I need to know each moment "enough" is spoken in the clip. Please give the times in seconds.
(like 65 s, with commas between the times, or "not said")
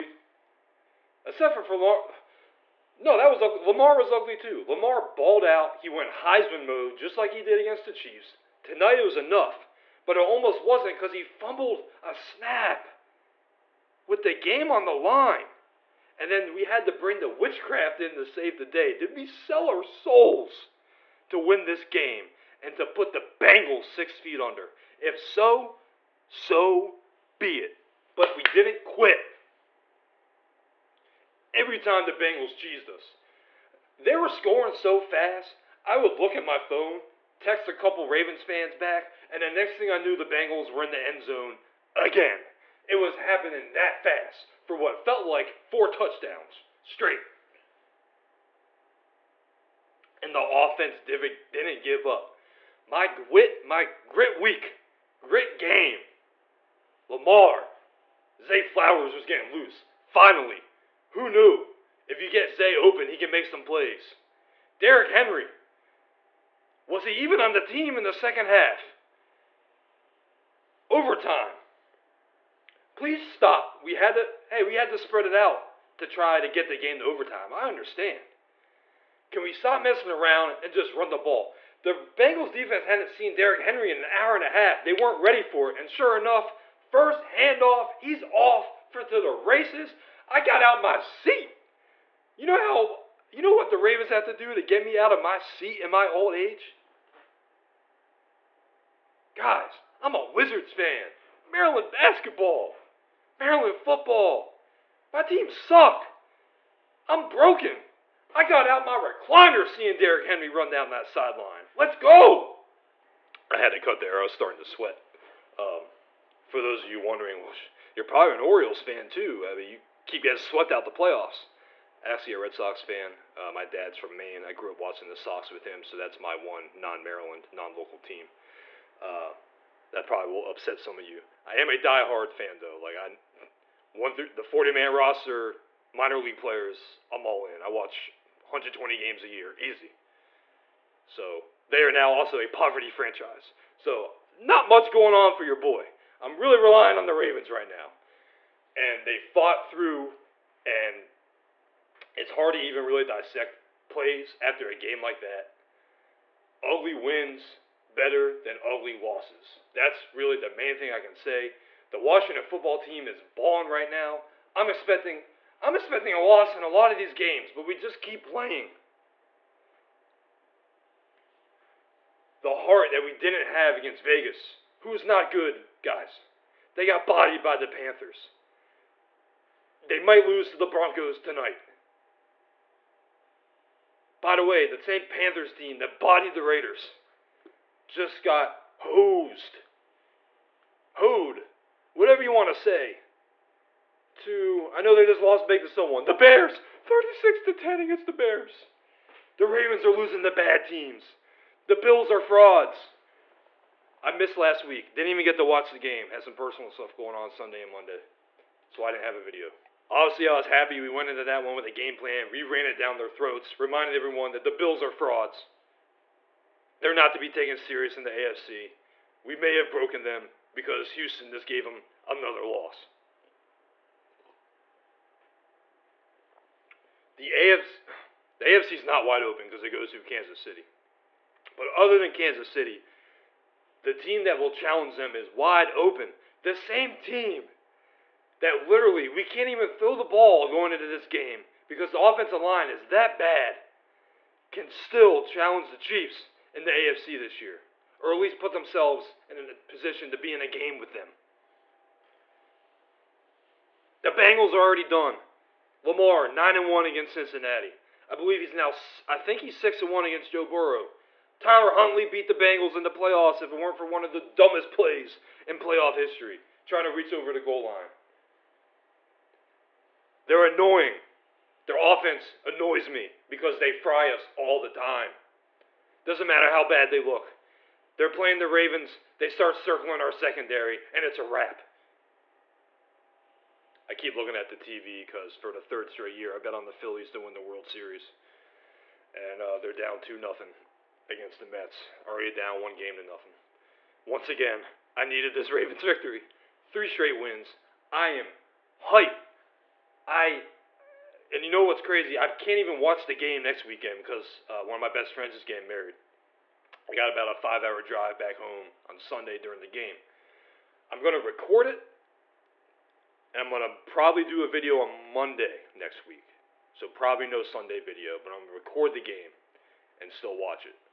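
9 s, 86 s.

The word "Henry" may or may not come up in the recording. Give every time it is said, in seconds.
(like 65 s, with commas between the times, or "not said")
65 s, 83 s, 110 s.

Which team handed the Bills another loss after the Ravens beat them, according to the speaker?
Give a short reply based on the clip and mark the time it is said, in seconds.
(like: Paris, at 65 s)
Houston, at 220 s.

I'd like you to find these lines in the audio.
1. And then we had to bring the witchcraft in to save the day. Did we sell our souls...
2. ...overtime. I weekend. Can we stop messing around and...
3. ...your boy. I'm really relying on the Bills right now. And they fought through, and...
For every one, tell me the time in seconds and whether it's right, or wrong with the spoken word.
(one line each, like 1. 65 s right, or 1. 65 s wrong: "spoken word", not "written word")
1. 16 s right
2. 77 s wrong: "understand", not "weekend"
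3. 145 s wrong: "Ravens", not "Bills".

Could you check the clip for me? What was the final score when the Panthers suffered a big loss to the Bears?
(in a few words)
36 to 10.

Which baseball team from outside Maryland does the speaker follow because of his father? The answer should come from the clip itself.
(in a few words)
Red Sox.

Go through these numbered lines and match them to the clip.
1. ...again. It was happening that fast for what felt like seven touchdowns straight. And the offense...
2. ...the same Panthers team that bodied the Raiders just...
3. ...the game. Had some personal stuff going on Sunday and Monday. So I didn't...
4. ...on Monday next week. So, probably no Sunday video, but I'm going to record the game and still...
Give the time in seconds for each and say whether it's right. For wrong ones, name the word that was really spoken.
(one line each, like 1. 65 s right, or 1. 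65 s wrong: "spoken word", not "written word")
1. 41 s wrong: "four", not "seven"
2. 184 s right
3. 205 s right
4. 314 s right.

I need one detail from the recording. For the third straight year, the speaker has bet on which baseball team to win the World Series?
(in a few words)
Phillies.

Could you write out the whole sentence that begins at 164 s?
I'm expecting I'm expecting a loss in a lot of these games, but we just keep playing.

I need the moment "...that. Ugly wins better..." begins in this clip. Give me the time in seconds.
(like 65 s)
155 s.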